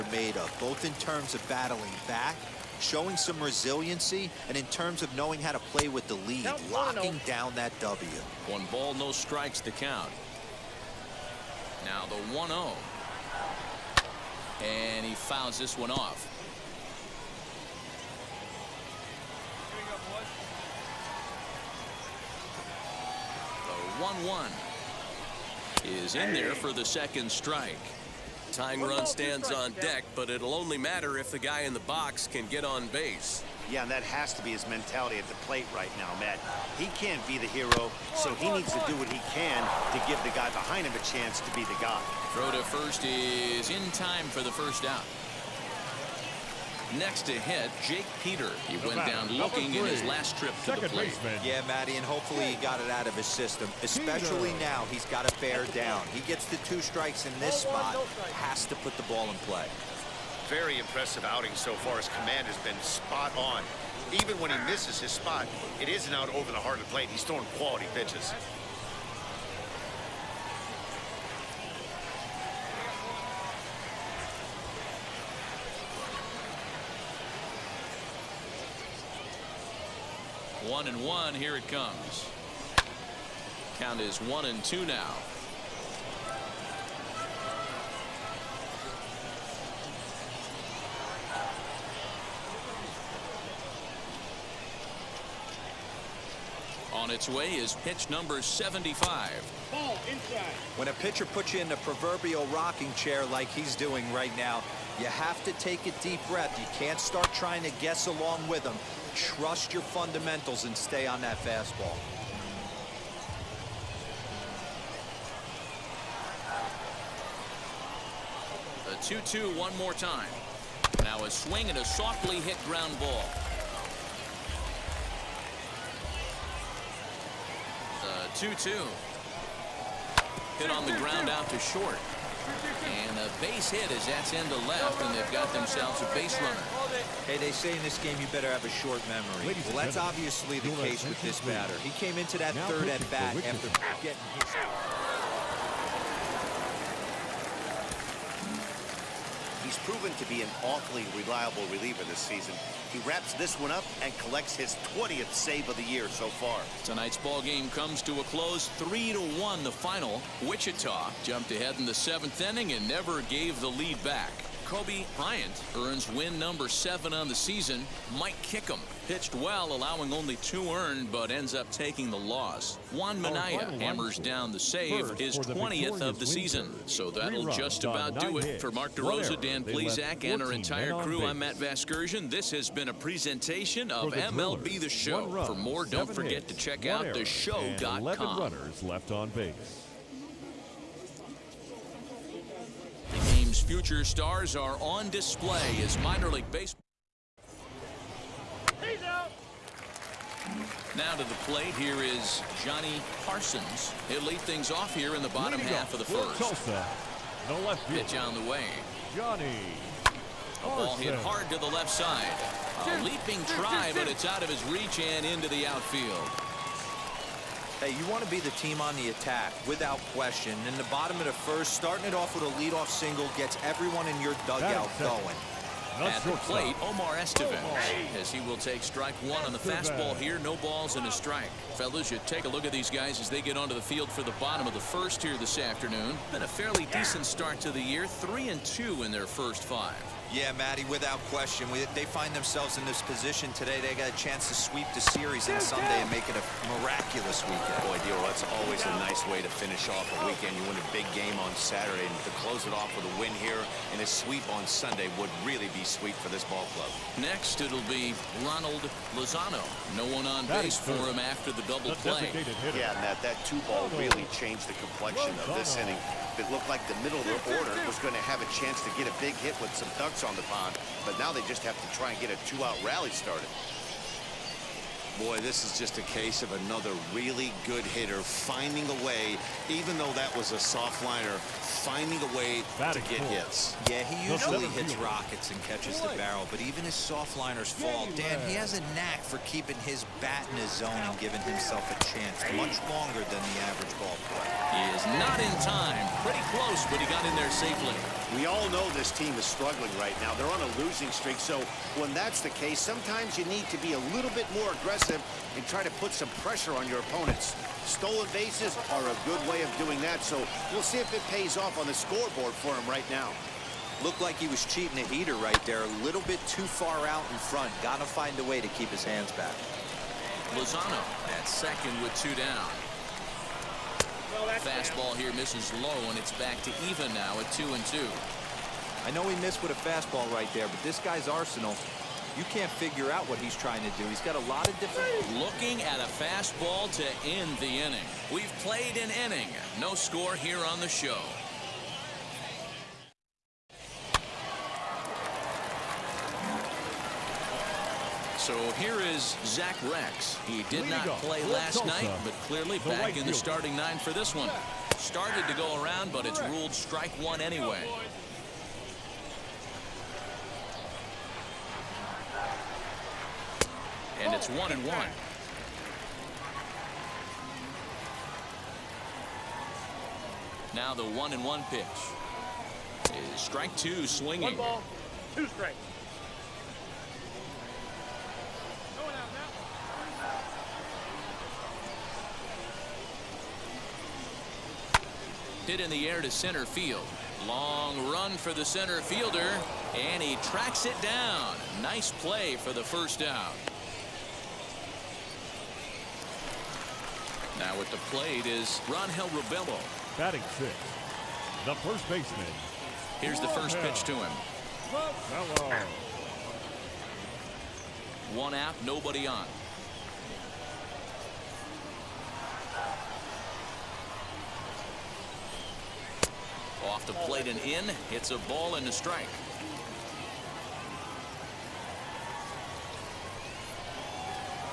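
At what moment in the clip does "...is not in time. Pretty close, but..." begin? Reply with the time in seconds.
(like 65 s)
294 s.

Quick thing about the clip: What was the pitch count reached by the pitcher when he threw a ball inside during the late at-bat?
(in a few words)
75.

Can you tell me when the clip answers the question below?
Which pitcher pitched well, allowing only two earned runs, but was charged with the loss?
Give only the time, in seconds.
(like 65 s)
168 s.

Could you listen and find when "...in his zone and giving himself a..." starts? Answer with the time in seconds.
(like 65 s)
290 s.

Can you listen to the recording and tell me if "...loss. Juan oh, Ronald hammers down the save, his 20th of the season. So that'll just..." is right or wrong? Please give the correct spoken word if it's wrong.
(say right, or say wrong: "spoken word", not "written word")
wrong: "Mania", not "Ronald".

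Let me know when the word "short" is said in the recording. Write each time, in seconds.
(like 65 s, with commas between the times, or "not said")
131 s, 138 s.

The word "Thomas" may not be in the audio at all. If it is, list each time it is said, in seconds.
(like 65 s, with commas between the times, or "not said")
not said.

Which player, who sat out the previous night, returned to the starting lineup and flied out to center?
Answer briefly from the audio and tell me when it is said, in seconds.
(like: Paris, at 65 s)
Zach Reks, at 349 s.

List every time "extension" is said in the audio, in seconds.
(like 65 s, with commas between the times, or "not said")
not said.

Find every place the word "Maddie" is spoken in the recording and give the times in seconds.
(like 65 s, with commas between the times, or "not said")
51 s, 240 s.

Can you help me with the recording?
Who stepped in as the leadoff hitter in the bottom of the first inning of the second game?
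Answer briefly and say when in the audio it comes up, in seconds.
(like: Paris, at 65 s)
Johnny Parsons, at 202 s.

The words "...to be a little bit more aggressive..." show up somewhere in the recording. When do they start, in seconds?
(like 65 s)
303 s.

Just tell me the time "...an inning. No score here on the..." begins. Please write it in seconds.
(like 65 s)
338 s.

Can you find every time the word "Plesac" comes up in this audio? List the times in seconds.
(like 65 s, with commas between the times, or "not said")
179 s.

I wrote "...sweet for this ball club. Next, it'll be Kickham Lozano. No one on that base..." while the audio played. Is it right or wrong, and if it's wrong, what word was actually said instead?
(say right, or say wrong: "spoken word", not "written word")
wrong: "Ronald", not "Kickham".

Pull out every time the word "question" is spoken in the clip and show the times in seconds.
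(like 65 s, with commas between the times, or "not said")
220 s, 241 s.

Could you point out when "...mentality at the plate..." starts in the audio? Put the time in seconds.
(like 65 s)
34 s.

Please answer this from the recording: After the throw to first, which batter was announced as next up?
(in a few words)
Jake Peter.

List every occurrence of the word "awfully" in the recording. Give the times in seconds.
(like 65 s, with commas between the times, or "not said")
150 s.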